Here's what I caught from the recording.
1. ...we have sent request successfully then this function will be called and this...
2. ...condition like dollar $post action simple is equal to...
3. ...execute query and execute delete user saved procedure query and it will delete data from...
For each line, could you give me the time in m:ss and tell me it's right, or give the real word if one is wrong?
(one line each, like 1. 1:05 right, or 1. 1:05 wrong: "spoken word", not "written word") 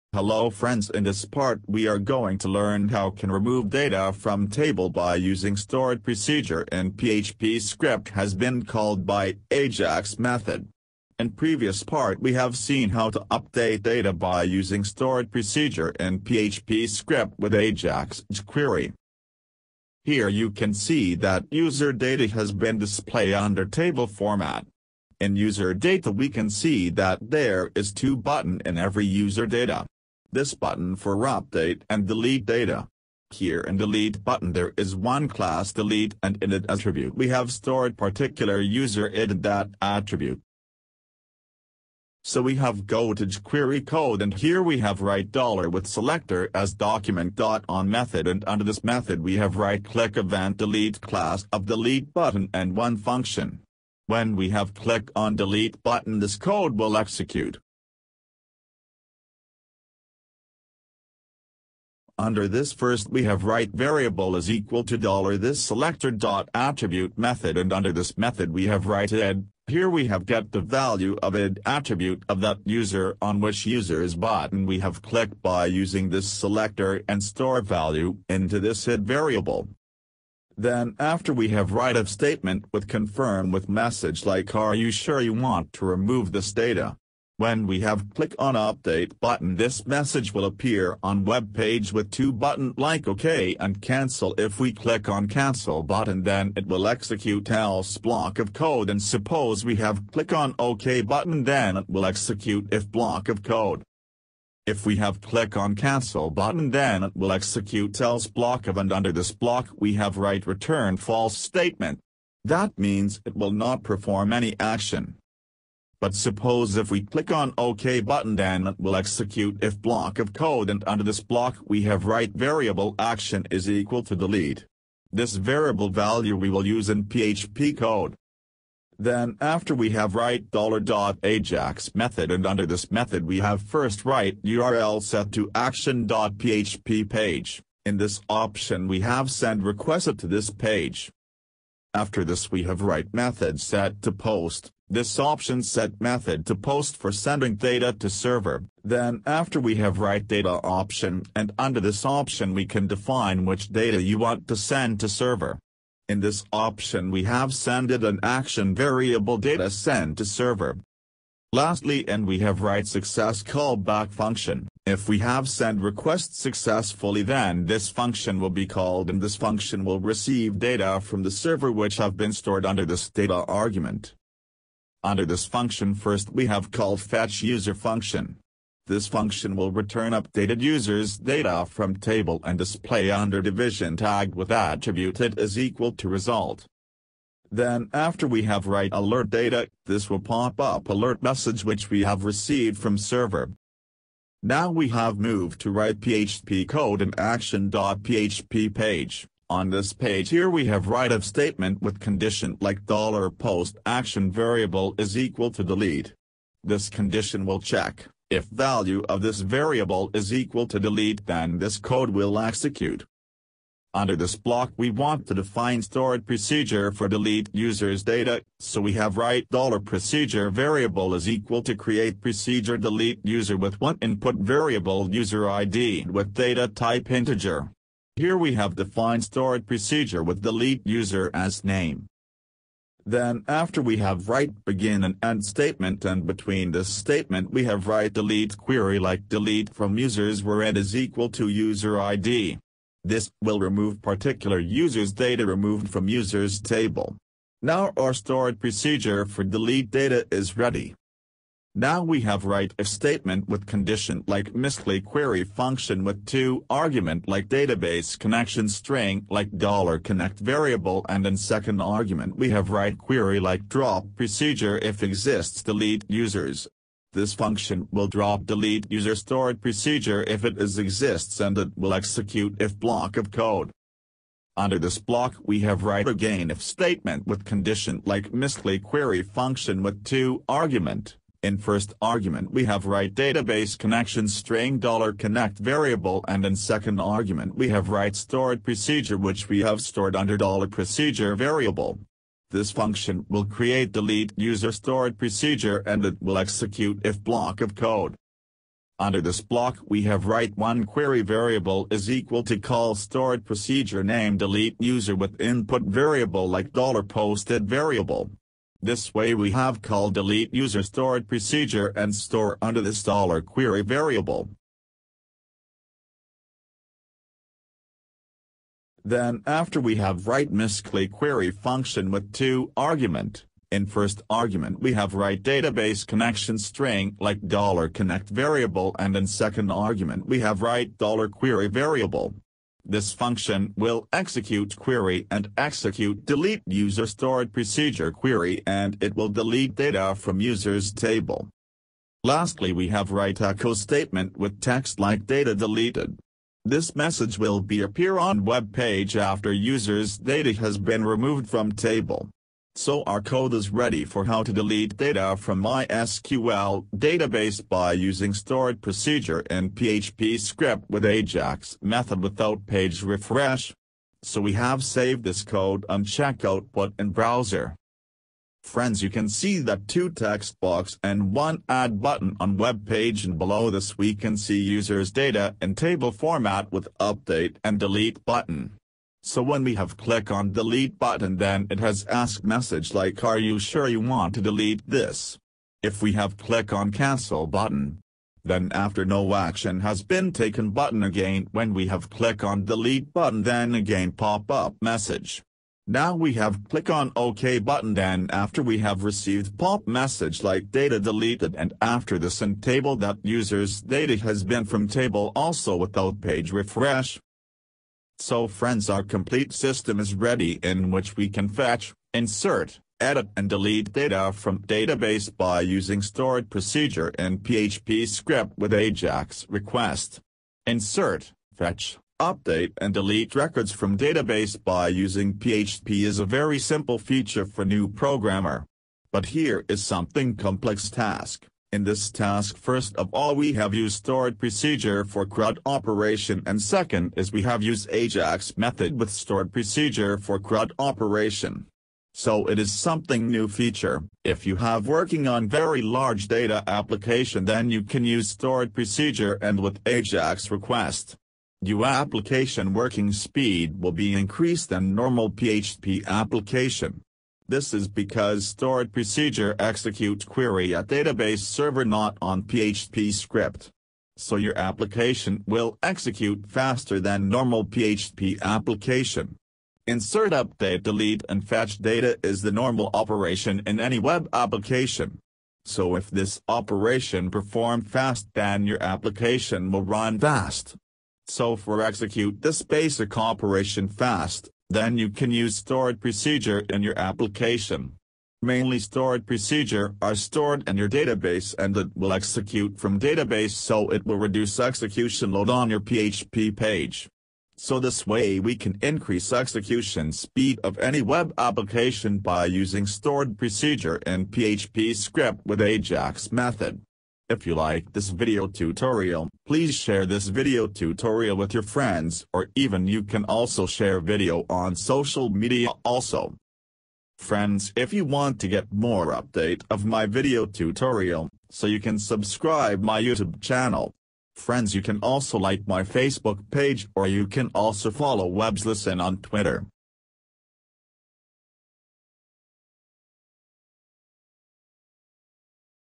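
1. 2:45 right
2. 3:21 wrong: "variable", not "simple"
3. 5:34 wrong: "stored", not "saved".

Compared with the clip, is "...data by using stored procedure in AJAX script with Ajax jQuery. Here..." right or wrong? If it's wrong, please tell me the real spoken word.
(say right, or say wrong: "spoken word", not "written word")
wrong: "PHP", not "AJAX".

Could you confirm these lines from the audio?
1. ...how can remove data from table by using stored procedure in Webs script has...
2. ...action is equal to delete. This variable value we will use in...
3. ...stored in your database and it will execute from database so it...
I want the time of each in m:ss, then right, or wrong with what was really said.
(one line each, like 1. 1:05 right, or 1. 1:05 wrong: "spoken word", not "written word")
1. 0:02 wrong: "PHP", not "Webs"
2. 2:02 right
3. 8:10 right.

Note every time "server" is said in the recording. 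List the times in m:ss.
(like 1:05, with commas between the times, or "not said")
2:28, 2:35, 2:40, 2:51, 3:12, 7:41.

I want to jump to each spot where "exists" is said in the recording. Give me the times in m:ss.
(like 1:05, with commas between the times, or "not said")
4:25, 4:30.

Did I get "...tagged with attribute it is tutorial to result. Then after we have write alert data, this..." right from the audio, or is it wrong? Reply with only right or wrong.
wrong.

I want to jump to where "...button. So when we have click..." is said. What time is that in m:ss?
6:18.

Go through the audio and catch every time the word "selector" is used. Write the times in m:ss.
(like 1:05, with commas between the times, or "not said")
0:45, 1:05, 1:16.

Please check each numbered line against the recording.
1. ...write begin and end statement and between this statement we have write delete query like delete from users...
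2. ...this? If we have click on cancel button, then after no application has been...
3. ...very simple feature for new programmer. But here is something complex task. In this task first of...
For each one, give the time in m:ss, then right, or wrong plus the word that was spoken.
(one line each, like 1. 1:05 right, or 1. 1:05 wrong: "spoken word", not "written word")
1. 3:54 right
2. 6:24 wrong: "action", not "application"
3. 7:06 right.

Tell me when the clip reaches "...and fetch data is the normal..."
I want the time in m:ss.
7:51.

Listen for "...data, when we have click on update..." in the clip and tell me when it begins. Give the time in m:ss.
1:26.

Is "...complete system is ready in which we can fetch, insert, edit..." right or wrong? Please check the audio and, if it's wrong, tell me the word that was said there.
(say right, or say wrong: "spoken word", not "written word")
right.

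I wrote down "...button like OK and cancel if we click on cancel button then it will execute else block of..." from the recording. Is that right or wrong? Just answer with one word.
right.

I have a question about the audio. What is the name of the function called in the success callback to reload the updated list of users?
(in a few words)
fetch user.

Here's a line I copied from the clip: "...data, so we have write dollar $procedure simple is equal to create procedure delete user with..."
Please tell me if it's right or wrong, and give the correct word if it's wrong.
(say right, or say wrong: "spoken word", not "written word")
wrong: "variable", not "simple".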